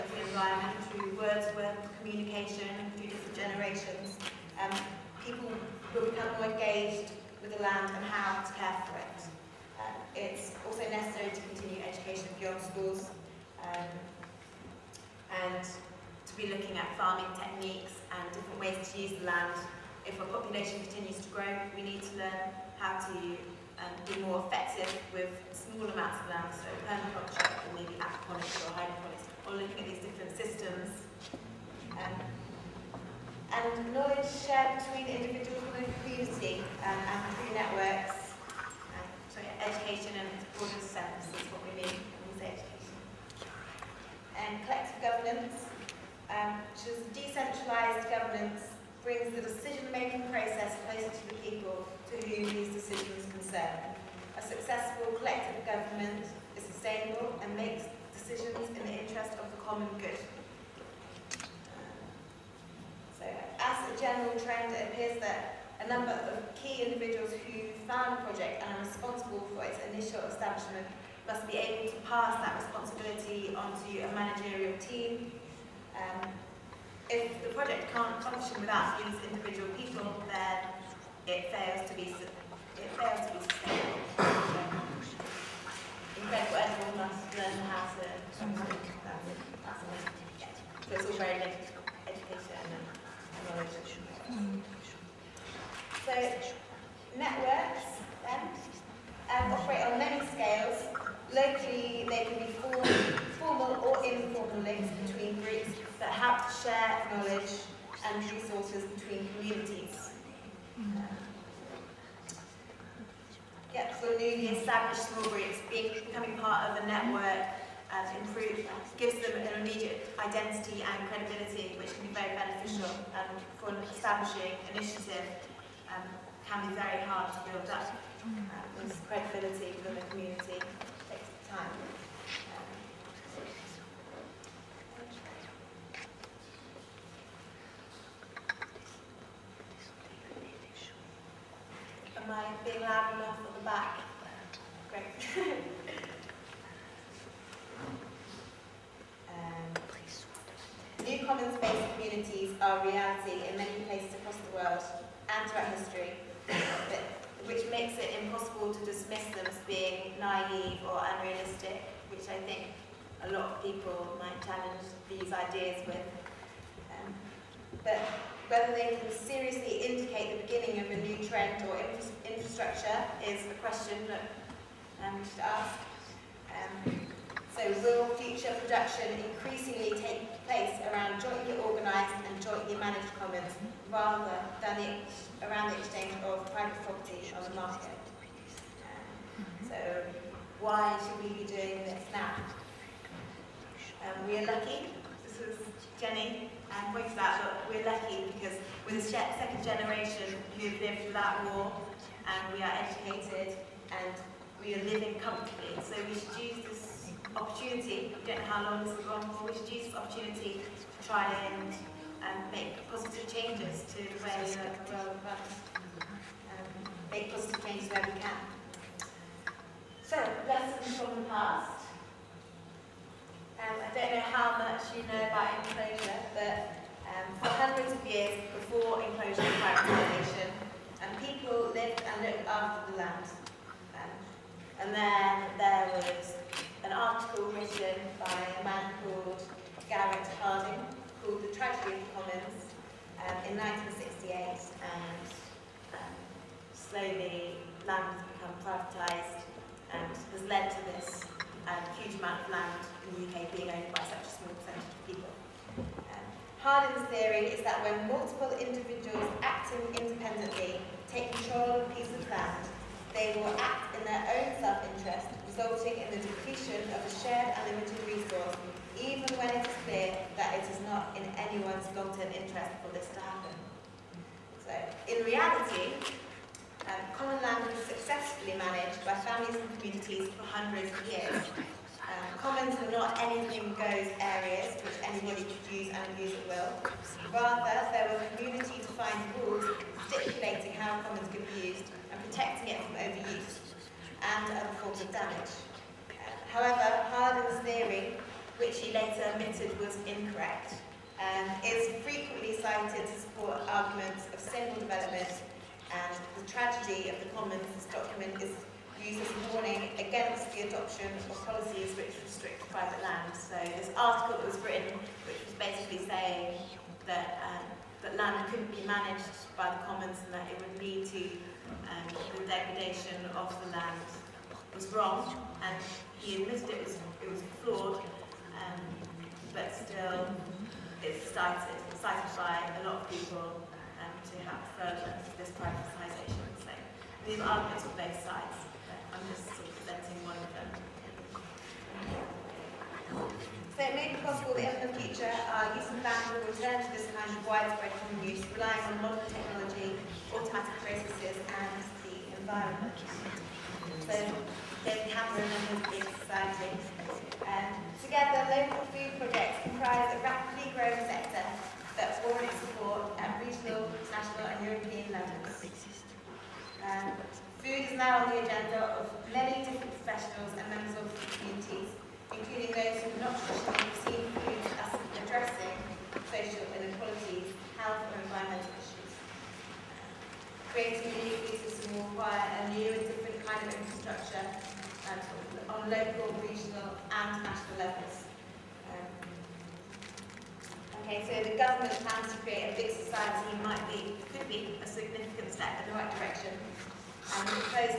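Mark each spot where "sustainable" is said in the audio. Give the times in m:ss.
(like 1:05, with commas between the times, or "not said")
0:56, 1:23.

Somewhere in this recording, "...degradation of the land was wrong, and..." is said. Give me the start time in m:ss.
5:22.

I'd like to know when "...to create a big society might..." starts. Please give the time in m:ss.
6:32.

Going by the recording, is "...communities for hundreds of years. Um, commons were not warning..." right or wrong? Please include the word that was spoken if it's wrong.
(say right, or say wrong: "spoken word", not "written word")
wrong: "anything", not "warning".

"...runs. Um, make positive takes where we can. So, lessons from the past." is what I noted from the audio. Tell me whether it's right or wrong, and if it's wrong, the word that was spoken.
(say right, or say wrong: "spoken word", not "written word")
wrong: "changes", not "takes".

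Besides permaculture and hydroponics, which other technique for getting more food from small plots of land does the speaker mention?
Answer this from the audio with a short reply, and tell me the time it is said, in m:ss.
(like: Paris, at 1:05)
aquaponics, at 0:27.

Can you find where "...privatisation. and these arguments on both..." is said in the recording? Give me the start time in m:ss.
5:35.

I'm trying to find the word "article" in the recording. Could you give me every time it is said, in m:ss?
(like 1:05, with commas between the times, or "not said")
3:56, 5:13.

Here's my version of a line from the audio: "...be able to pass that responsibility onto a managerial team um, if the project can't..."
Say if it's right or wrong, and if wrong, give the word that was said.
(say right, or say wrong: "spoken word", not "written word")
right.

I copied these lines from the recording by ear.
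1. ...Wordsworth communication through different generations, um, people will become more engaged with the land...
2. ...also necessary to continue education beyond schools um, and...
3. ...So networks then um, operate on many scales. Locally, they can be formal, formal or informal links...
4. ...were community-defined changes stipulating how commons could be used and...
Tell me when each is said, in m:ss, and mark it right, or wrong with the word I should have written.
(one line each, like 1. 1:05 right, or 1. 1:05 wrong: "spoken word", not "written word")
1. 0:01 right
2. 0:10 right
3. 1:36 right
4. 4:48 wrong: "rules", not "changes".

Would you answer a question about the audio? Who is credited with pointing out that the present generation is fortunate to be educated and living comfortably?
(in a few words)
Jenny.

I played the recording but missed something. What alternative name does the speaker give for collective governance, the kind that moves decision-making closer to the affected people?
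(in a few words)
decentralised governance.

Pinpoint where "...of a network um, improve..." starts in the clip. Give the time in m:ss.
1:56.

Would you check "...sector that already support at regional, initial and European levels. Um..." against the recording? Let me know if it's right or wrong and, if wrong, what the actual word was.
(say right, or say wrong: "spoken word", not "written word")
wrong: "national", not "initial".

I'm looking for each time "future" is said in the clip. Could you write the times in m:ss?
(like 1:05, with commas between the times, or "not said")
2:58, 5:45.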